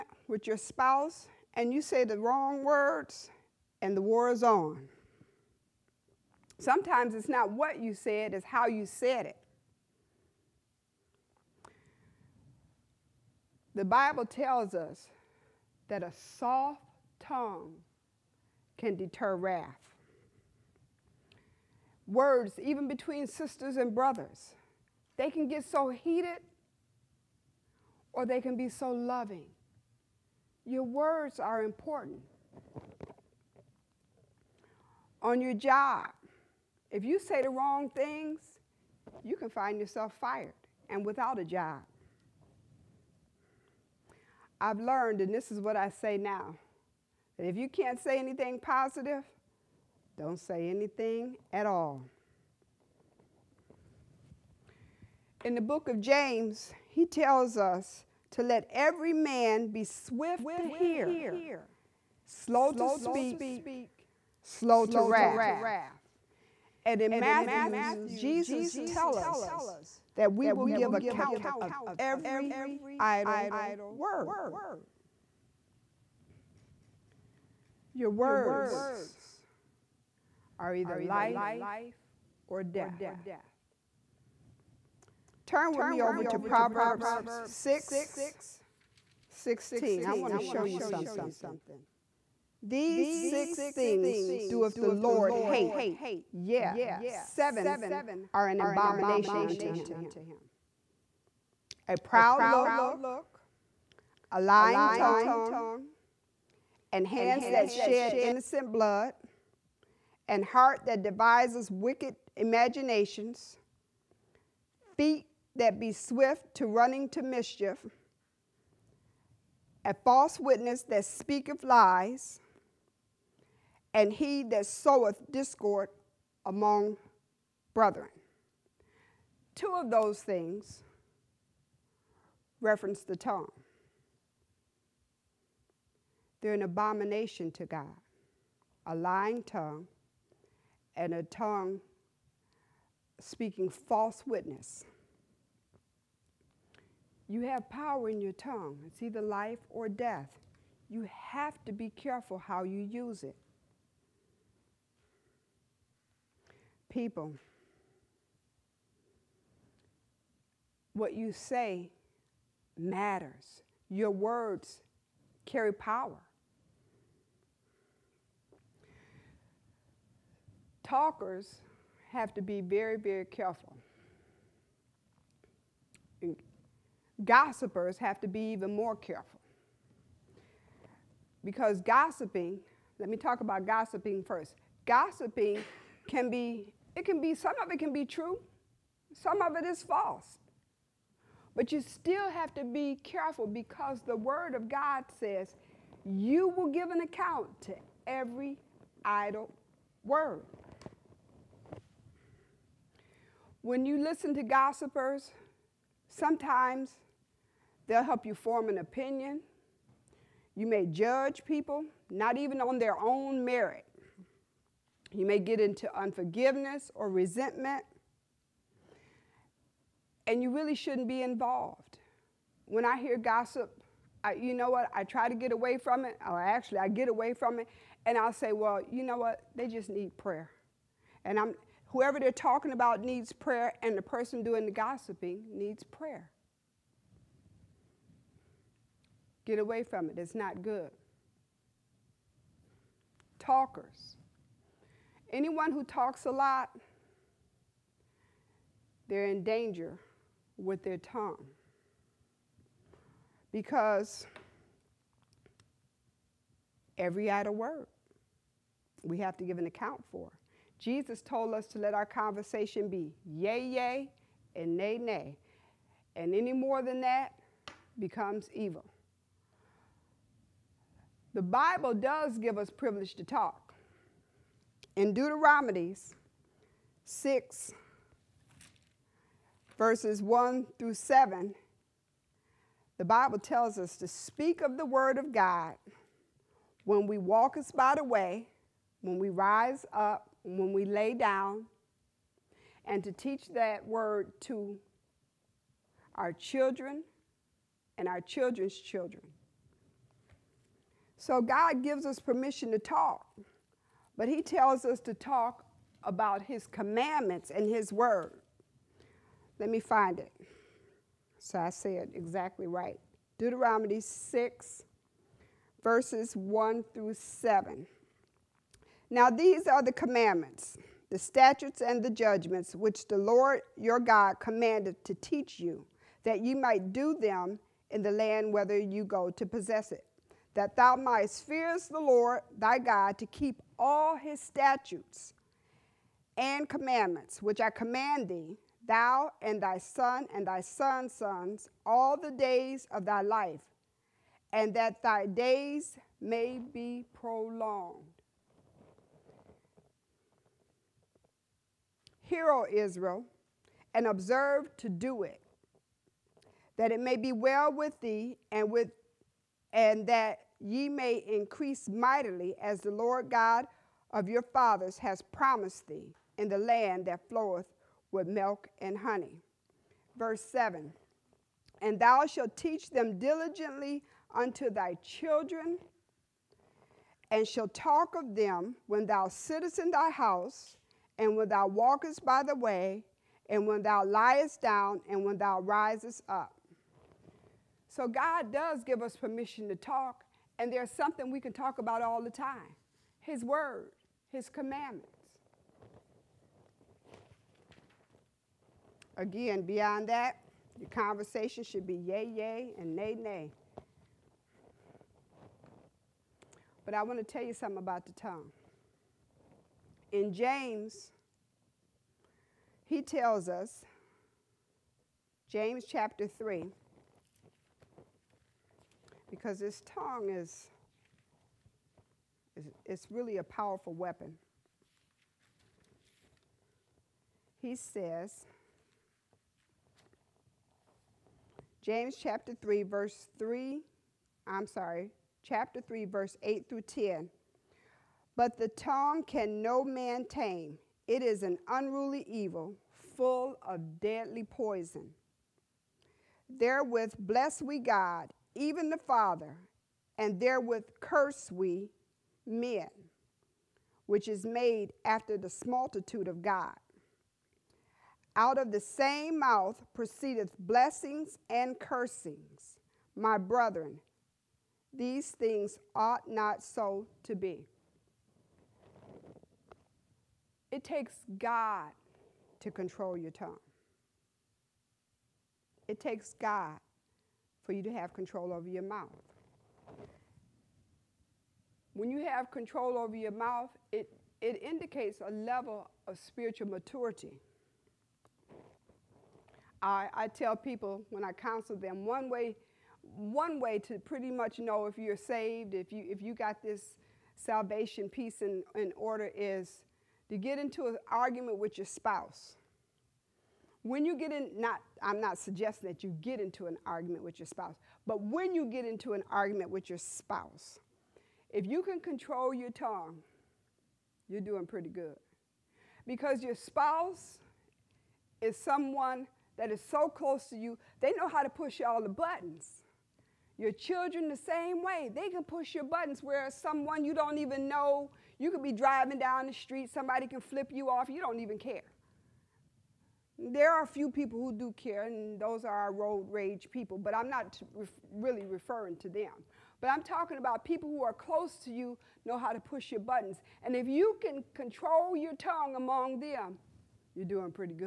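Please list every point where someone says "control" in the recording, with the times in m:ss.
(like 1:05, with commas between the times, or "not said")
7:52, 7:58, 8:02, 8:31, 9:04.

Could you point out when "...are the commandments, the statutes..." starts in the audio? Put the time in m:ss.
5:19.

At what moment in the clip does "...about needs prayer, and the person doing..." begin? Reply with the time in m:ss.
3:52.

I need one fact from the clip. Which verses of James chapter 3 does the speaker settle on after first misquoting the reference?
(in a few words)
8 through 10.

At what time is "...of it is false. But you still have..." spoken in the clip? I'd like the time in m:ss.
3:09.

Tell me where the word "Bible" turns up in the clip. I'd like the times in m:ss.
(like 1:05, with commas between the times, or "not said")
0:13, 4:31, 4:43.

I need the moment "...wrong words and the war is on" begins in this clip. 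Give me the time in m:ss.
0:02.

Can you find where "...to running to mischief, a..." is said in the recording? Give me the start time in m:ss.
1:56.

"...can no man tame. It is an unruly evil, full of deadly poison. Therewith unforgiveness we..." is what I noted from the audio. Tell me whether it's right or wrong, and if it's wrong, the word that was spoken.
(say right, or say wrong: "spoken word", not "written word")
wrong: "bless", not "unforgiveness".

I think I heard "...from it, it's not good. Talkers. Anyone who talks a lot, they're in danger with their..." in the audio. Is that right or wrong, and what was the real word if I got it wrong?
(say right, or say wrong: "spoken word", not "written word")
right.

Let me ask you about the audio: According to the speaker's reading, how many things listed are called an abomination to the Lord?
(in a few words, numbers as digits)
7.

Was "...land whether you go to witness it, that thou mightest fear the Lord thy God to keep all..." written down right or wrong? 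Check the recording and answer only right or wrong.
wrong.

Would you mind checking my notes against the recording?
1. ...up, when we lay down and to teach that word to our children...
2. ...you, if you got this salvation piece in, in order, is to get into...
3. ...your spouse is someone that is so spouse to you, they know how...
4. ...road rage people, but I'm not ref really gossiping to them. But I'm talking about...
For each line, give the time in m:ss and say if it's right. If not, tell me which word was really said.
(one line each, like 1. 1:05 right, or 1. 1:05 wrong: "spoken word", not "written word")
1. 4:49 right
2. 8:15 right
3. 8:36 wrong: "close", not "spouse"
4. 8:55 wrong: "referring", not "gossiping".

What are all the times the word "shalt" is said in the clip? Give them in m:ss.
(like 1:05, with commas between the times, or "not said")
6:12, 6:17.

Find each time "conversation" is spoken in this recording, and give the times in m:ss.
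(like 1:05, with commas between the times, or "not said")
4:22, 6:40.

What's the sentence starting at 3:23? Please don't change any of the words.
When you listen to gossipers, sometimes they'll help you form an opinion.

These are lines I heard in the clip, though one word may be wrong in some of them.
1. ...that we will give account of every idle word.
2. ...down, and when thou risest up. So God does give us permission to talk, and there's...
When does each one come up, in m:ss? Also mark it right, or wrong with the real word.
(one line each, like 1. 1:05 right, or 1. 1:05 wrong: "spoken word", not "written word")
1. 1:10 right
2. 6:24 right.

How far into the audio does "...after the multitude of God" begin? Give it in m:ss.
7:35.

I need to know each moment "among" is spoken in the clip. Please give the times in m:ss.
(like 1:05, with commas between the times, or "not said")
2:06, 9:05.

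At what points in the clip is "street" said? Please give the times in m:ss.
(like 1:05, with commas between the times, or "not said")
8:49.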